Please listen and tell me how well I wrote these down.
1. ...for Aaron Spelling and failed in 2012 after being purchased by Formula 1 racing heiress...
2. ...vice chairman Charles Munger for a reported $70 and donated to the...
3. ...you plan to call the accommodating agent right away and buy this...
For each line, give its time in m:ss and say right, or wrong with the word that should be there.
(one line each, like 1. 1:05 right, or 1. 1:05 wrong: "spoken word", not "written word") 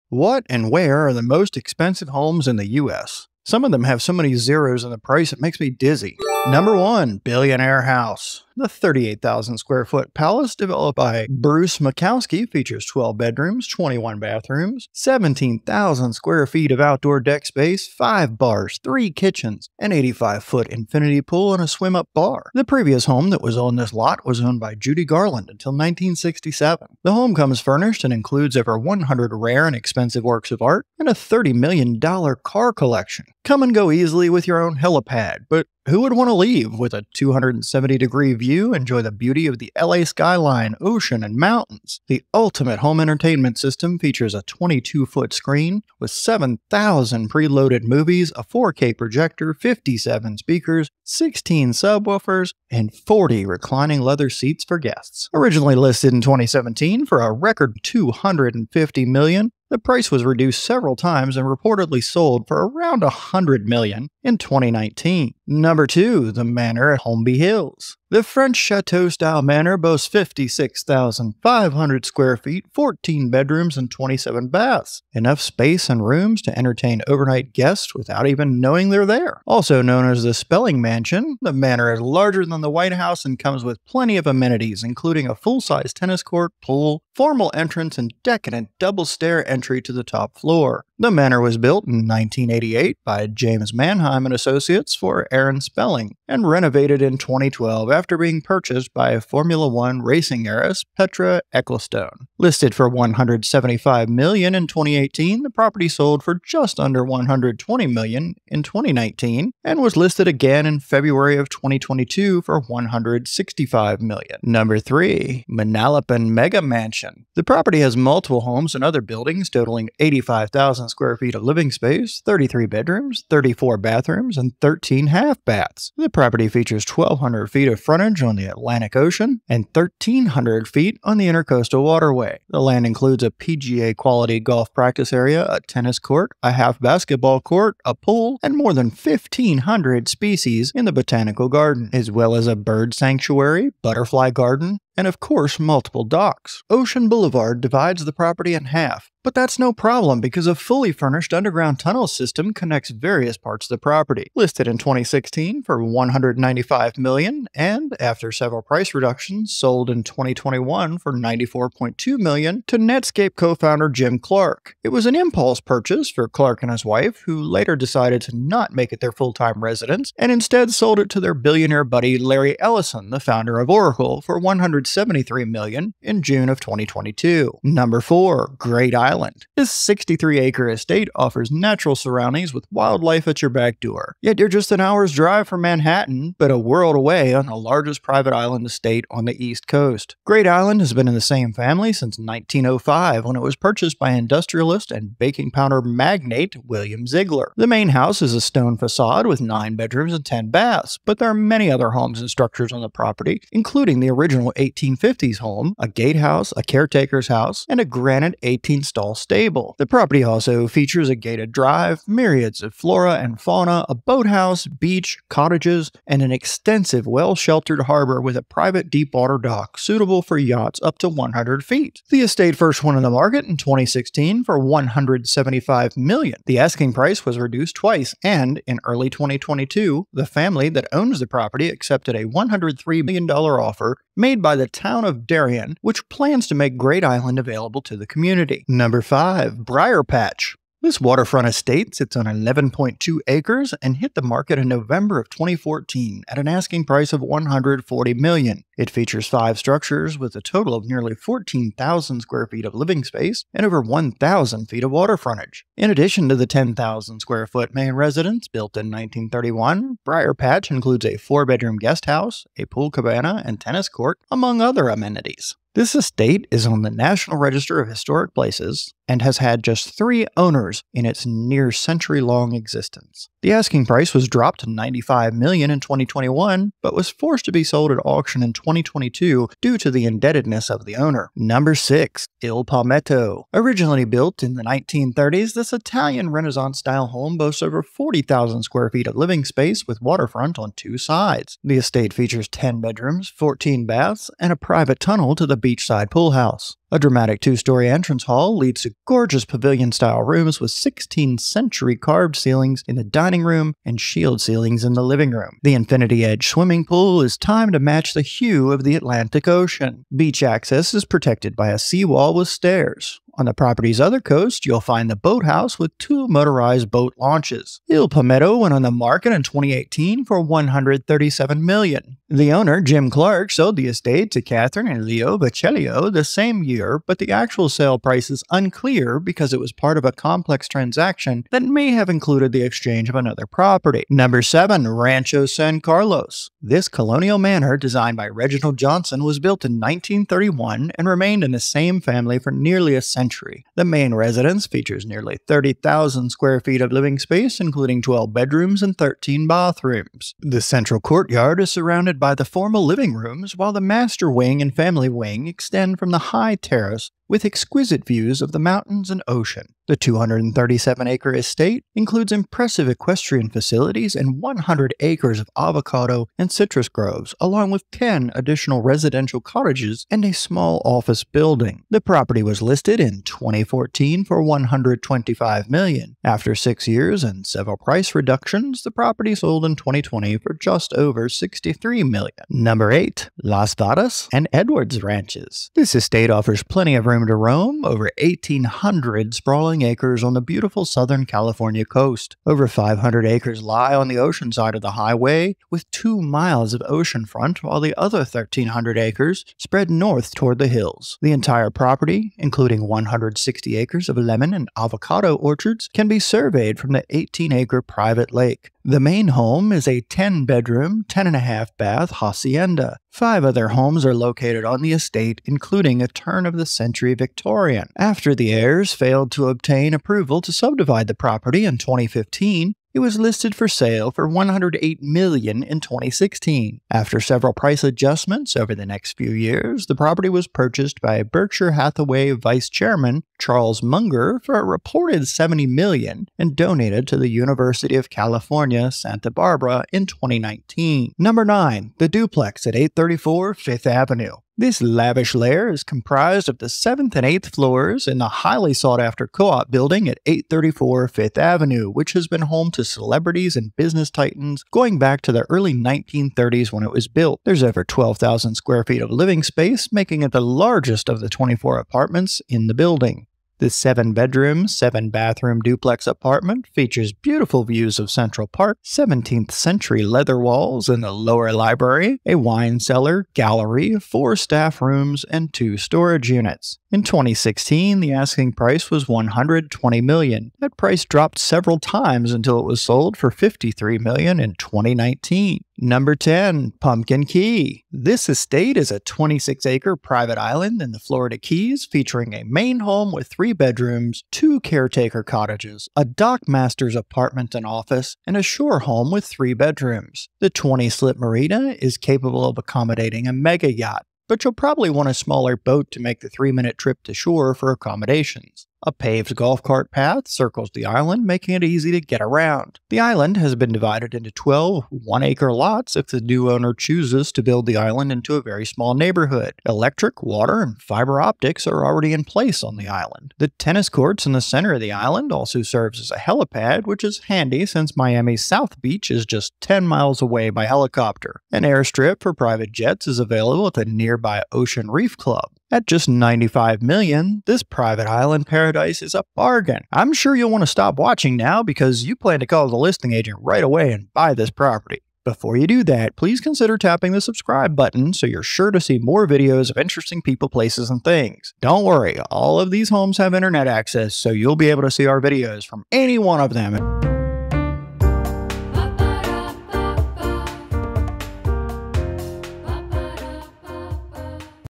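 1. 1:34 wrong: "renovated", not "failed"
2. 7:12 right
3. 9:02 wrong: "listing", not "accommodating".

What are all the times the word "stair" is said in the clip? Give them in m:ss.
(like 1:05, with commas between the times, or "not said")
1:29, 5:12.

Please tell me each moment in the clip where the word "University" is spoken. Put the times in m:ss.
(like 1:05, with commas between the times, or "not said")
7:17.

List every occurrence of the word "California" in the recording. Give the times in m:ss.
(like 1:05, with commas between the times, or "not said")
6:31, 7:18.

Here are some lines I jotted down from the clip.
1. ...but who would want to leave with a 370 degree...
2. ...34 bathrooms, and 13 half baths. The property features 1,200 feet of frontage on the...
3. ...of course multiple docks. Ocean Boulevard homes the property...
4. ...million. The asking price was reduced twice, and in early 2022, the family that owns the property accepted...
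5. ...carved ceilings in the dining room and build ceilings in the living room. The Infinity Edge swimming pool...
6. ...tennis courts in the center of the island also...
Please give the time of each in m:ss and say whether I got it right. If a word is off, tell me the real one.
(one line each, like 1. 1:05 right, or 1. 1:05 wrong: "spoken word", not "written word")
1. 0:35 wrong: "270", not "370"
2. 2:03 right
3. 2:25 wrong: "divides", not "homes"
4. 3:45 right
5. 5:01 wrong: "shield", not "build"
6. 8:43 right.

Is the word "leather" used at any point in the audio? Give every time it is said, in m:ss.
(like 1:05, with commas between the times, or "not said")
0:54, 7:50.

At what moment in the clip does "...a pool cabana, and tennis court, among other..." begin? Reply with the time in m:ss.
4:22.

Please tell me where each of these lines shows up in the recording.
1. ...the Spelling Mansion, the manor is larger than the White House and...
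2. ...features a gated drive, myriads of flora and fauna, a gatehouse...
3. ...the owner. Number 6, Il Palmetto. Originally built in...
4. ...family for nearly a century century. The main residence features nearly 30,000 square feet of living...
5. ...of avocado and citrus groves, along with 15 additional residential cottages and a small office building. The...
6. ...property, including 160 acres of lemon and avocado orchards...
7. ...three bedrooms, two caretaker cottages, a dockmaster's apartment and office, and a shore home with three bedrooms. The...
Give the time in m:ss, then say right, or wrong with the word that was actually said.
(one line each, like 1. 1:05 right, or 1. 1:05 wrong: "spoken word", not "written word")
1. 1:20 right
2. 3:30 wrong: "boathouse", not "gatehouse"
3. 4:40 right
4. 5:41 right
5. 6:05 wrong: "10", not "15"
6. 6:41 right
7. 8:13 right.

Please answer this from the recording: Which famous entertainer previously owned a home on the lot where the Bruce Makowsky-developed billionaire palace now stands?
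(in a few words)
Judy Garland.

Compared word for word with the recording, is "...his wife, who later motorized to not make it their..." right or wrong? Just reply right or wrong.
wrong.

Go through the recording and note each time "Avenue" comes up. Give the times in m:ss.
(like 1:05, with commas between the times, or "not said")
7:23, 7:31.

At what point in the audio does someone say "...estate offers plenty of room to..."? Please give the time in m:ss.
6:25.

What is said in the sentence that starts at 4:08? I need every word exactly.
It features five structures with a total of nearly 14,000 square feet of living space and over 1,000 feet of water frontage.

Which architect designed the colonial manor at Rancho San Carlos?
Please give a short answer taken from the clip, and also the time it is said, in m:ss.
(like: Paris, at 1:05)
Reginald Johnson, at 5:38.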